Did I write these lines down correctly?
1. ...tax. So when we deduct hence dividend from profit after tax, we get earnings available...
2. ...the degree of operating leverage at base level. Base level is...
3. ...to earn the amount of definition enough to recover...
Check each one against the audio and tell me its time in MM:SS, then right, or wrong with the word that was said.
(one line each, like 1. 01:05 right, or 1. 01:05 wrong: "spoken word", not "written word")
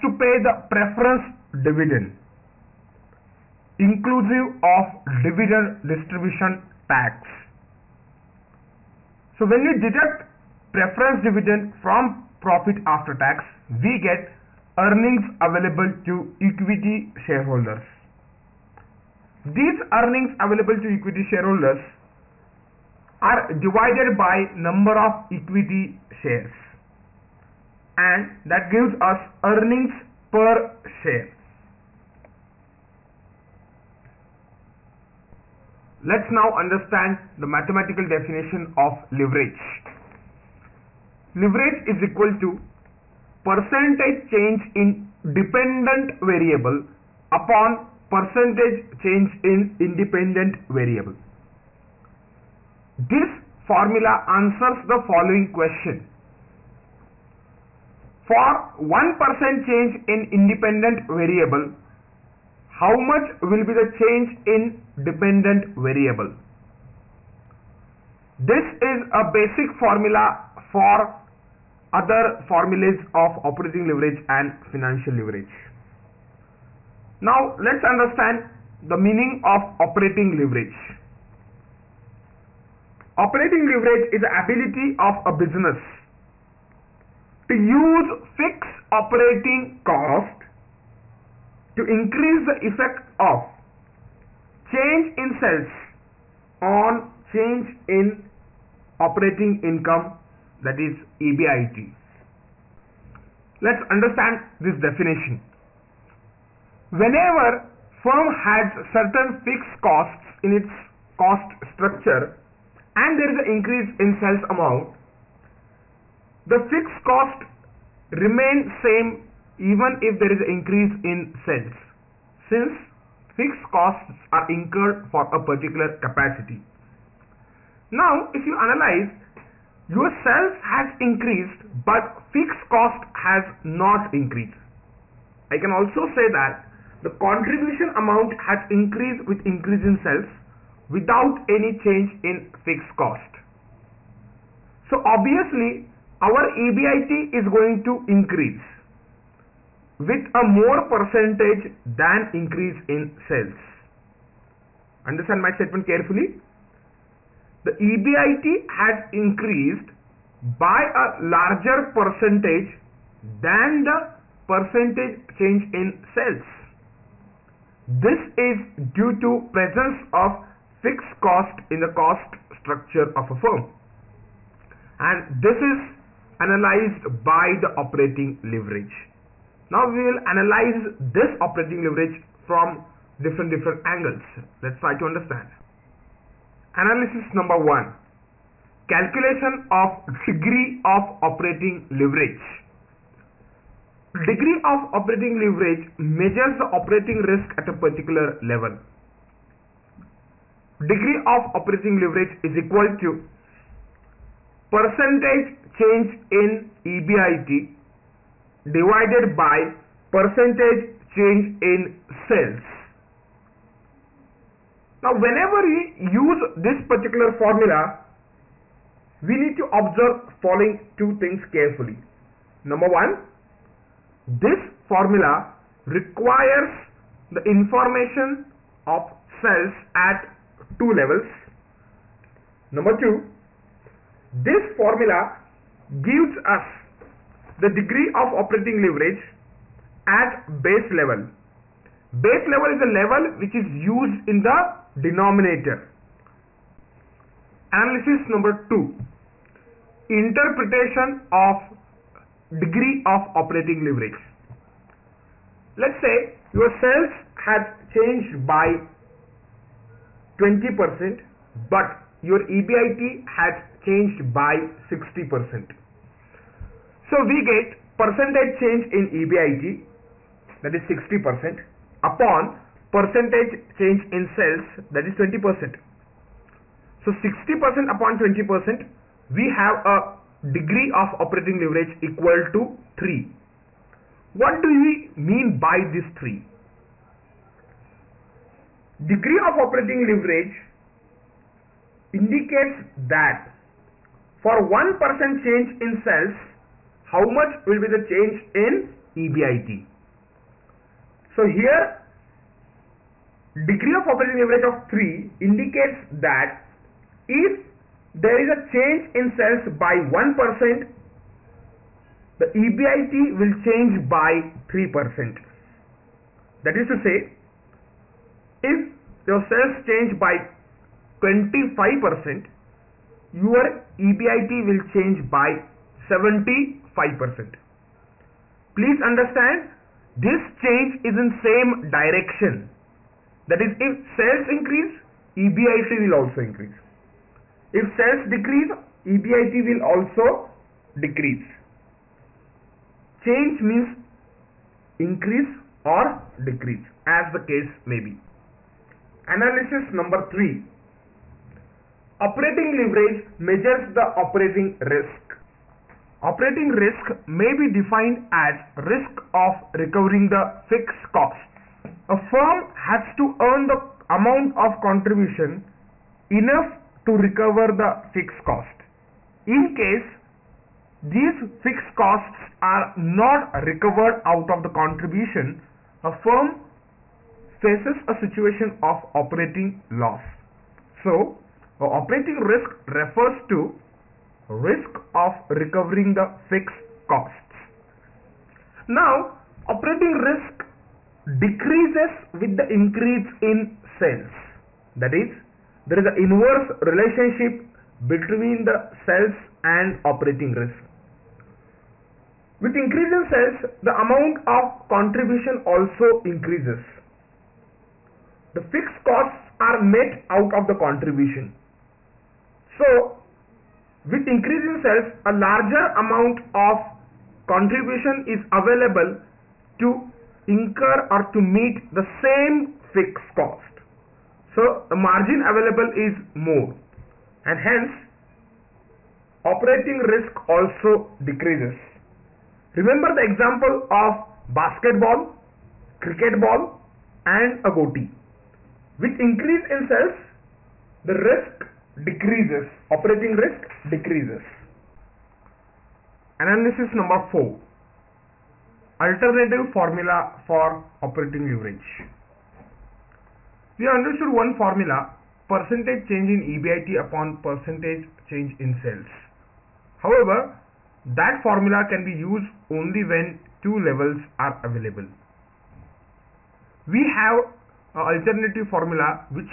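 1. 00:06 wrong: "preference", not "hence"
2. 03:57 right
3. 06:03 wrong: "contribution", not "definition".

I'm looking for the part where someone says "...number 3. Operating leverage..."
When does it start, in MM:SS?
05:49.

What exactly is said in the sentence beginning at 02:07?
Now if you analyze your sales has increased but fixed cost has not increased.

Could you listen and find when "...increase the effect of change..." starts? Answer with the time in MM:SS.
01:31.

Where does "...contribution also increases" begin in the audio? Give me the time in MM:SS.
06:44.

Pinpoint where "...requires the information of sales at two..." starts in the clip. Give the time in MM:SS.
03:45.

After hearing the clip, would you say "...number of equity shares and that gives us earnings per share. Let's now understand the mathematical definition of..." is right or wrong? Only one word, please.
right.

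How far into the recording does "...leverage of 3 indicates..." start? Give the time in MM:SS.
05:04.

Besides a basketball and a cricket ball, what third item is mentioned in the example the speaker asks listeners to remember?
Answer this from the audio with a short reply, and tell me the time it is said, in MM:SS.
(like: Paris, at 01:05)
A goatee, at 07:17.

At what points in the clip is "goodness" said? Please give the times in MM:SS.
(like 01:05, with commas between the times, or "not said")
not said.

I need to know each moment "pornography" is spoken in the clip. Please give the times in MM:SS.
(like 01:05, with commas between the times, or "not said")
not said.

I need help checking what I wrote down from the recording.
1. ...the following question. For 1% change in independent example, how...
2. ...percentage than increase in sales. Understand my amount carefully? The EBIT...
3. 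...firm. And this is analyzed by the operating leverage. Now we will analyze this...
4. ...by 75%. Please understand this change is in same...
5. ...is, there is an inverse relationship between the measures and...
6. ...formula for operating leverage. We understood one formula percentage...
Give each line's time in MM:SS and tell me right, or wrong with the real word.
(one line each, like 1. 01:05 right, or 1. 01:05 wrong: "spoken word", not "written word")
1. 00:54 wrong: "variable", not "example"
2. 02:30 wrong: "statement", not "amount"
3. 02:53 right
4. 05:25 right
5. 06:35 wrong: "sales", not "measures"
6. 07:29 right.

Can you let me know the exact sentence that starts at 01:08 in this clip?
This is a basic formula for other formulas of operating leverage and financial leverage.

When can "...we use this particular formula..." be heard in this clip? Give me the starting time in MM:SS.
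03:35.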